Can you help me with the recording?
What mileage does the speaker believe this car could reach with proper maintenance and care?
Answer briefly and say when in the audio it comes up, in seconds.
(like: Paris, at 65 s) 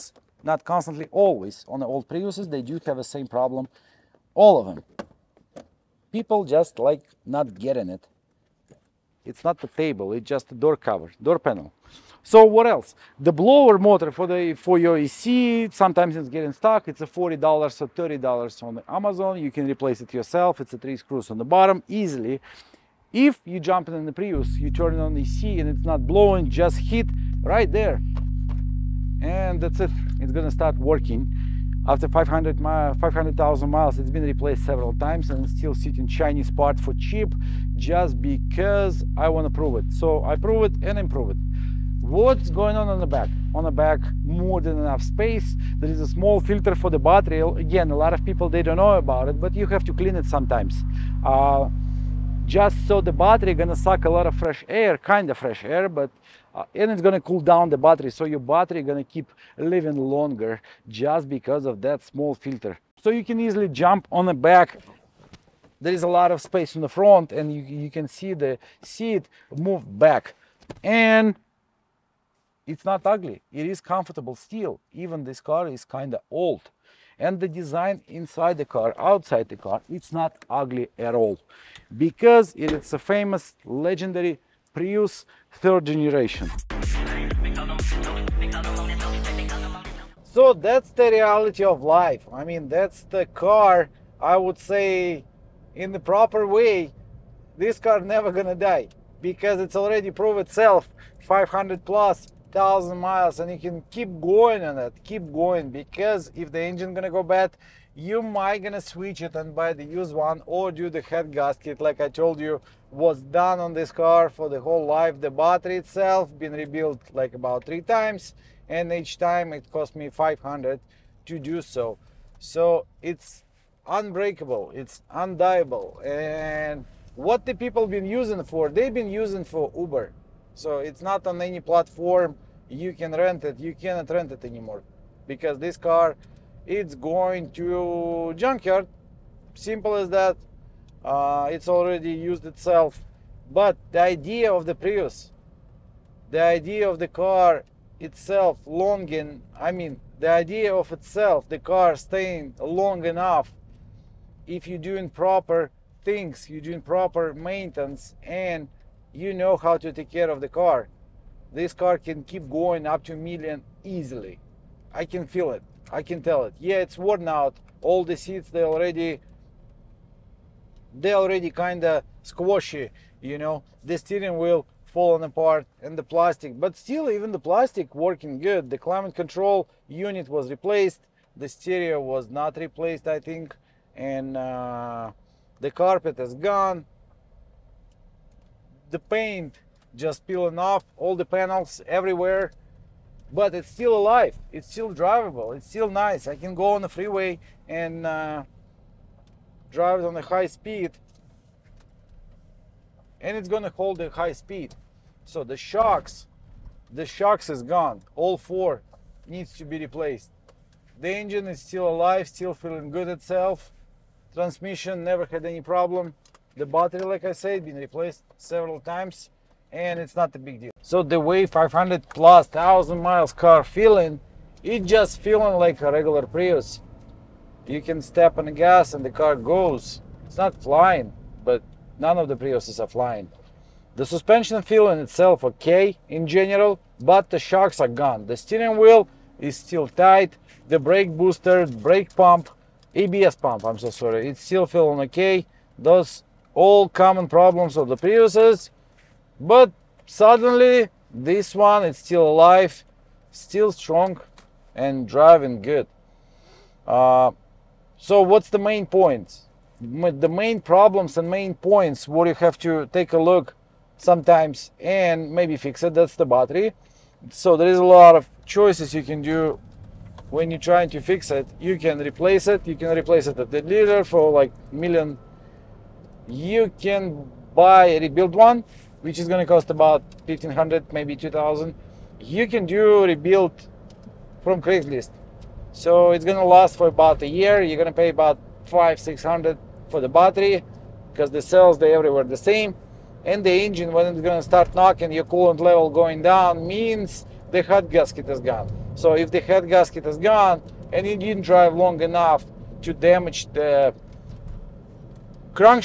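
a million, at 163 s.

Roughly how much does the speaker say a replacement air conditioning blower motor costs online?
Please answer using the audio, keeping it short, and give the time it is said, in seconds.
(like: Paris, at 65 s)
$40 or $30, at 17 s.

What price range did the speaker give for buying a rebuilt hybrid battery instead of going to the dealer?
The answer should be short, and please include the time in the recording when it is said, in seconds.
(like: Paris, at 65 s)
1500 to 2000, at 280 s.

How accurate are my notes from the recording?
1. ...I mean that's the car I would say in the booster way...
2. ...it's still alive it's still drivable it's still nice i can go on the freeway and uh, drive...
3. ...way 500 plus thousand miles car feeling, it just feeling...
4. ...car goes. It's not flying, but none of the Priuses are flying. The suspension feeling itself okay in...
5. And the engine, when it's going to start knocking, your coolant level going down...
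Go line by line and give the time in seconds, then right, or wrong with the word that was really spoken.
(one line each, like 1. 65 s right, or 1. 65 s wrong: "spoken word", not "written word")
1. 92 s wrong: "proper", not "booster"
2. 193 s right
3. 221 s right
4. 229 s right
5. 293 s right.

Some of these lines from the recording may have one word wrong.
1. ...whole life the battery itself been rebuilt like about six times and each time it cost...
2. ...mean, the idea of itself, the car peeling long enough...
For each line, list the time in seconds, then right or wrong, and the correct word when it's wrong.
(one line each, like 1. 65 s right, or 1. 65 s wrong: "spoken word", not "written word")
1. 114 s wrong: "three", not "six"
2. 149 s wrong: "staying", not "peeling".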